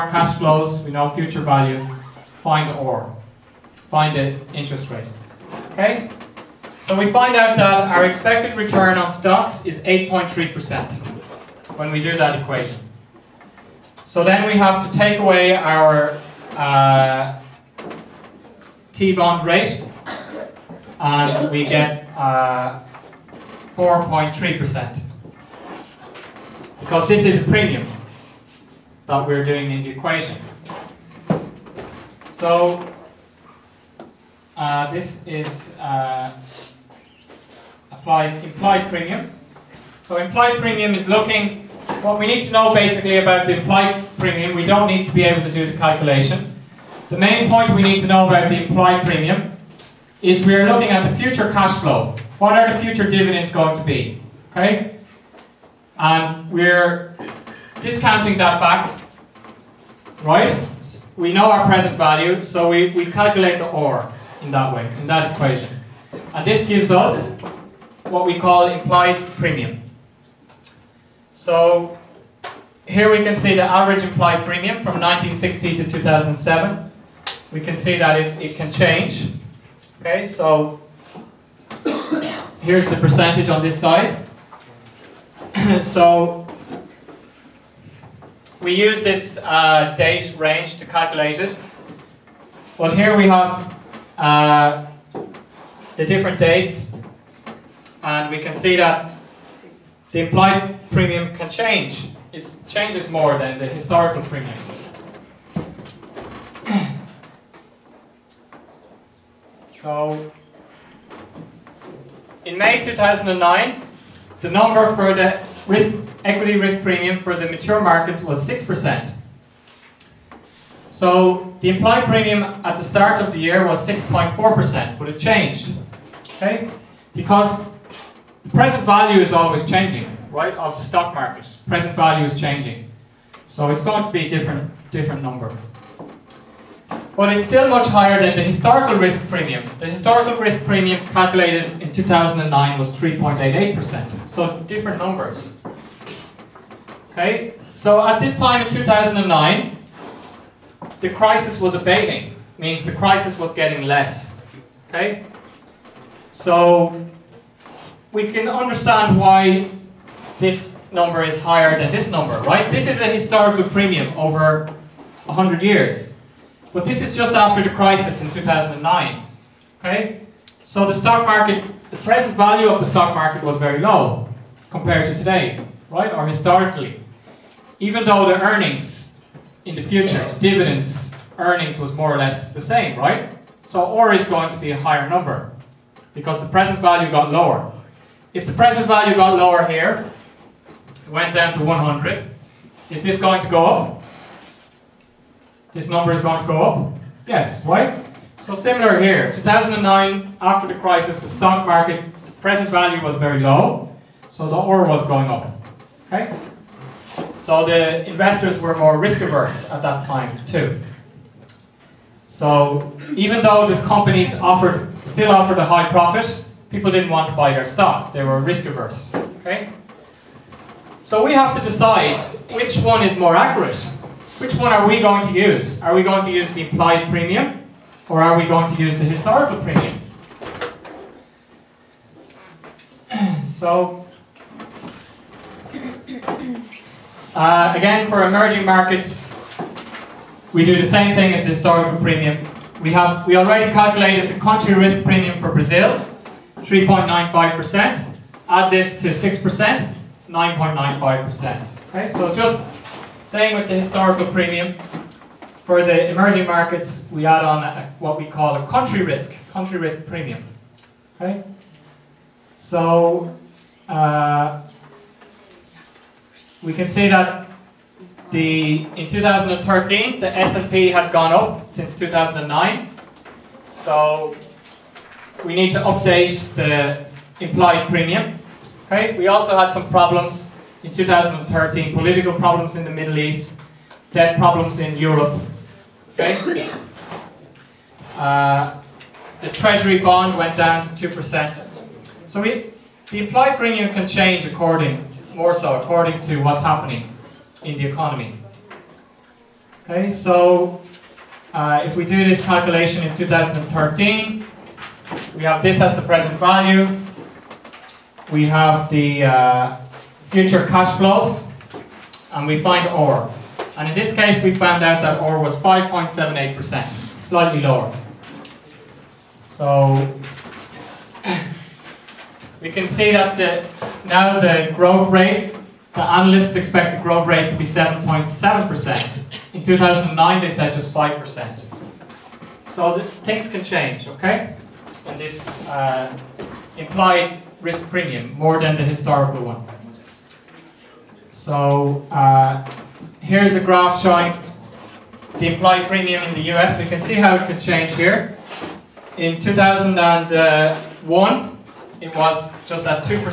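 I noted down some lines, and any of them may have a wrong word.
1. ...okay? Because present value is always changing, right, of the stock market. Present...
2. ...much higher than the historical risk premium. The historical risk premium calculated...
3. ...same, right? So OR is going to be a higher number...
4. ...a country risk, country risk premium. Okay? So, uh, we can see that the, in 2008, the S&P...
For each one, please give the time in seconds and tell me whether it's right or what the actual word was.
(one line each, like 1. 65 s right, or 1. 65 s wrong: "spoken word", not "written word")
1. 126 s right
2. 137 s right
3. 182 s right
4. 258 s wrong: "2013", not "2008".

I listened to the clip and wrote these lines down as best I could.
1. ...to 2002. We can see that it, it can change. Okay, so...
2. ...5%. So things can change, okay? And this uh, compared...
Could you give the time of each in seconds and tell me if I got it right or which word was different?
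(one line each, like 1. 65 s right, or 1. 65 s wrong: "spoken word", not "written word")
1. 75 s wrong: "2007", not "2002"
2. 330 s wrong: "implied", not "compared".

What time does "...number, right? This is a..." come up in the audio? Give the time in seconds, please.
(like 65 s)
162 s.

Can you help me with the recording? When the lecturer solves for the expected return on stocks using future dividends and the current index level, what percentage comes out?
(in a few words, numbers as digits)
8.3%.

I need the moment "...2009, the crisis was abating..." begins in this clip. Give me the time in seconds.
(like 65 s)
148 s.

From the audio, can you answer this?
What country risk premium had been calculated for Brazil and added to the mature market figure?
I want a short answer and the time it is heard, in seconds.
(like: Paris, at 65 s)
3.95%, at 246 s.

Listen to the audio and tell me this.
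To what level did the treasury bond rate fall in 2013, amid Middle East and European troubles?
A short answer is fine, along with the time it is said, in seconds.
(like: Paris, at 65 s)
2%, at 291 s.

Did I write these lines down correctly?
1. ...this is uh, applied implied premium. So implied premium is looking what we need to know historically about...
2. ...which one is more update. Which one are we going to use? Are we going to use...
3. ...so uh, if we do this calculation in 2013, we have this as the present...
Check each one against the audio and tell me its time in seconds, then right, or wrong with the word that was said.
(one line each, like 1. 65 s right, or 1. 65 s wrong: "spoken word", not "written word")
1. 34 s wrong: "basically", not "historically"
2. 222 s wrong: "accurate", not "update"
3. 300 s right.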